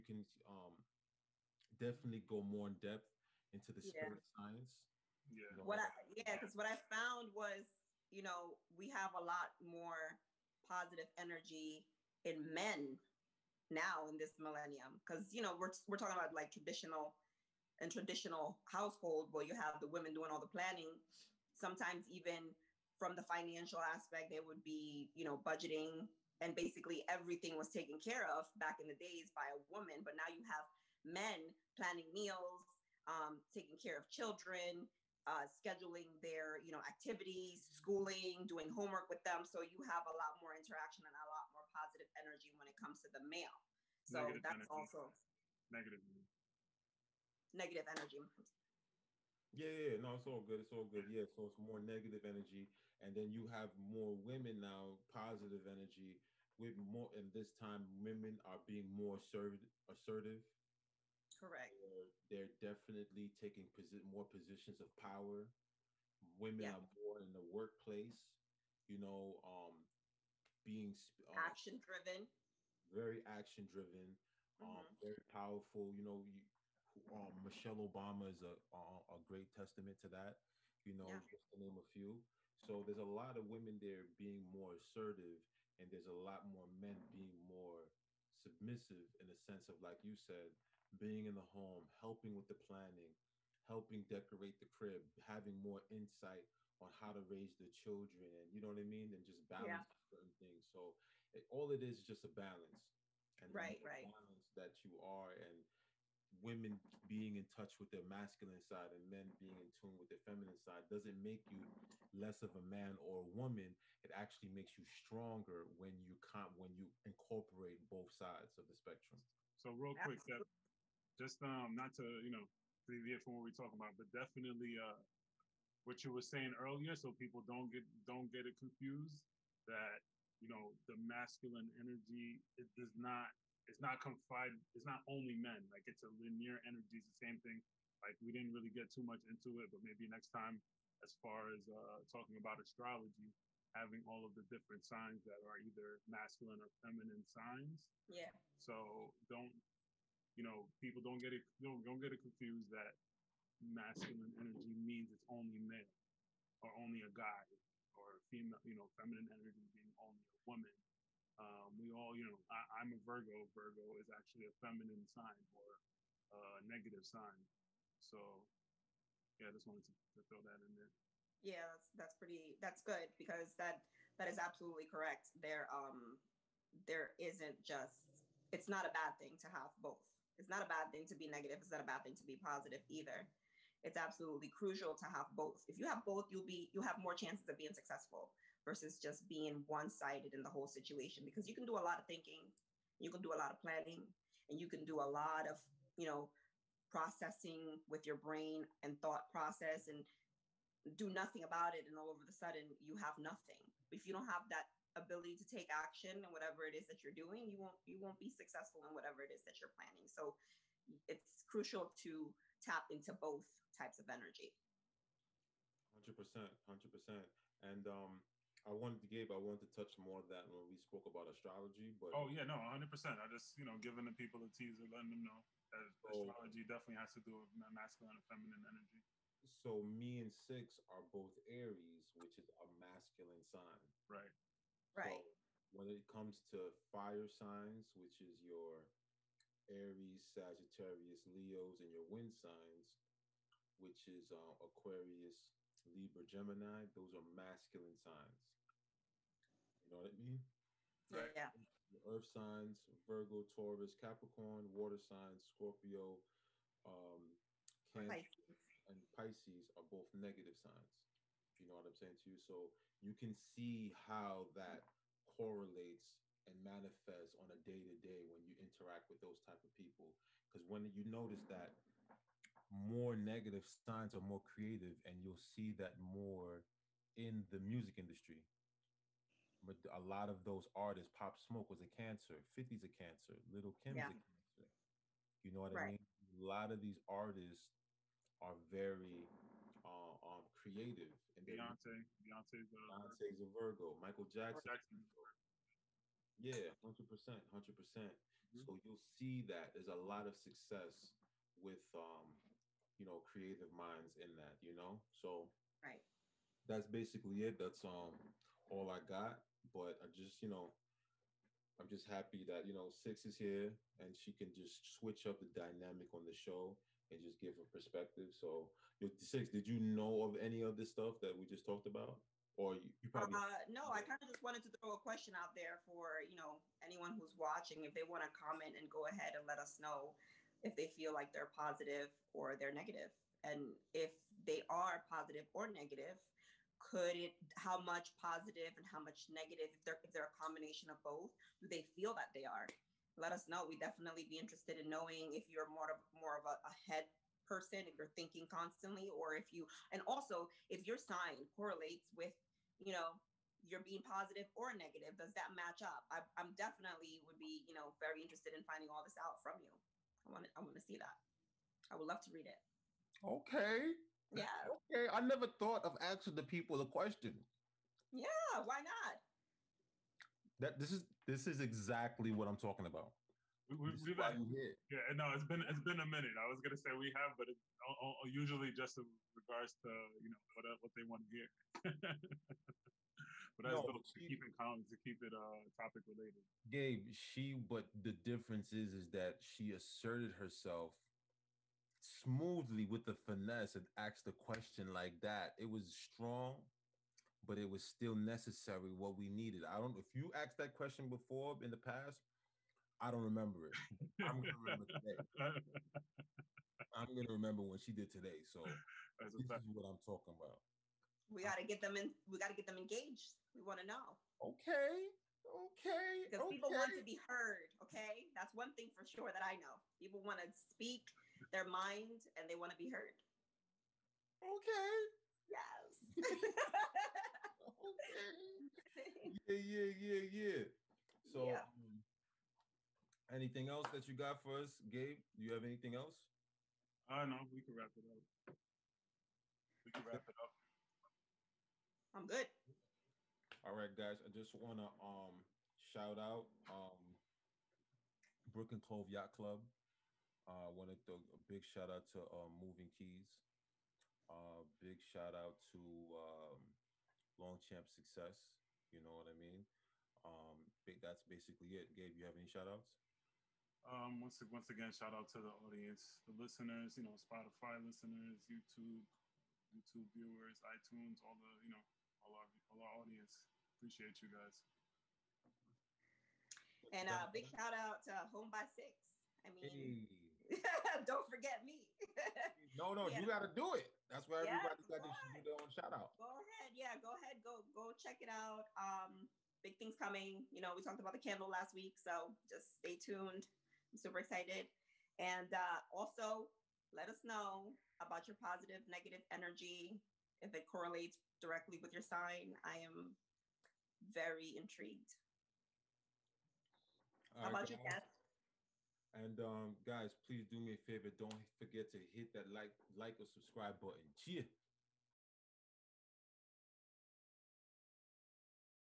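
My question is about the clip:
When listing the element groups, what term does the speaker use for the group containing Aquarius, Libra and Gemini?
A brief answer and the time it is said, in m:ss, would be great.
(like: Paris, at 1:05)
wind signs, at 4:02.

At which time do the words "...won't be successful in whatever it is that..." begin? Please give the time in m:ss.
3:27.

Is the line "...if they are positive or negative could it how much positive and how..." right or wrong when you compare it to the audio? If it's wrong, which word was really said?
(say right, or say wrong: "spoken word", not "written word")
right.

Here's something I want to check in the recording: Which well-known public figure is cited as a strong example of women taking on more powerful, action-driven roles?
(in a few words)
Michelle Obama.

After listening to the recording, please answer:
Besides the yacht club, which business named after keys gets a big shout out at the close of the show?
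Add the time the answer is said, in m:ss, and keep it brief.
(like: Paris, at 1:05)
Moving Keys, at 7:32.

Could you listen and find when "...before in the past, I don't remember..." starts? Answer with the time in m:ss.
6:41.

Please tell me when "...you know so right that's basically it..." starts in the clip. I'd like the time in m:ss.
5:04.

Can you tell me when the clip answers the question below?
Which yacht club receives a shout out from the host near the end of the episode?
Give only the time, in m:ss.
7:28.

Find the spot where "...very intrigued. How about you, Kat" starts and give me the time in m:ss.
8:24.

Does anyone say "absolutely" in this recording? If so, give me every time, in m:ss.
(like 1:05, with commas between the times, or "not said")
2:54, 3:03.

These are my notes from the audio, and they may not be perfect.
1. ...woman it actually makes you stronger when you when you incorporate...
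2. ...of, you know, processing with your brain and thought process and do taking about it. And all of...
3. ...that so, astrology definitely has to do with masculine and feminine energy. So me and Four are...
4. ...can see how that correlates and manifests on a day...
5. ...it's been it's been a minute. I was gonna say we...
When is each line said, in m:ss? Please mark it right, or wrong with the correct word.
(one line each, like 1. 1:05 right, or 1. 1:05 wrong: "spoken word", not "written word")
1. 1:53 right
2. 3:15 wrong: "nothing", not "taking"
3. 3:45 wrong: "Six", not "Four"
4. 4:23 right
5. 6:15 right.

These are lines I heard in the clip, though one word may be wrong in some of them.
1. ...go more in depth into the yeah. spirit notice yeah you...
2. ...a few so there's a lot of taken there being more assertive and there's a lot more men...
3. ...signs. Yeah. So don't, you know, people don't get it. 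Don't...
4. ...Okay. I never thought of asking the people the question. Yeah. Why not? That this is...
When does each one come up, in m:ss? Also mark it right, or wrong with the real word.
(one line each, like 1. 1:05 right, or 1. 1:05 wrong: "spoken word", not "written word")
1. 0:02 wrong: "science", not "notice"
2. 1:21 wrong: "women", not "taken"
3. 2:27 right
4. 6:04 right.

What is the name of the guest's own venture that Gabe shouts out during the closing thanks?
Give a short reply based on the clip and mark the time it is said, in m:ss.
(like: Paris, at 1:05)
Home by Six, at 7:58.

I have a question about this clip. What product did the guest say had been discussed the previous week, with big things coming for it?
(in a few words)
candle.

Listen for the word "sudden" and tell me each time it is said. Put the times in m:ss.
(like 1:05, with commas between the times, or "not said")
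3:22.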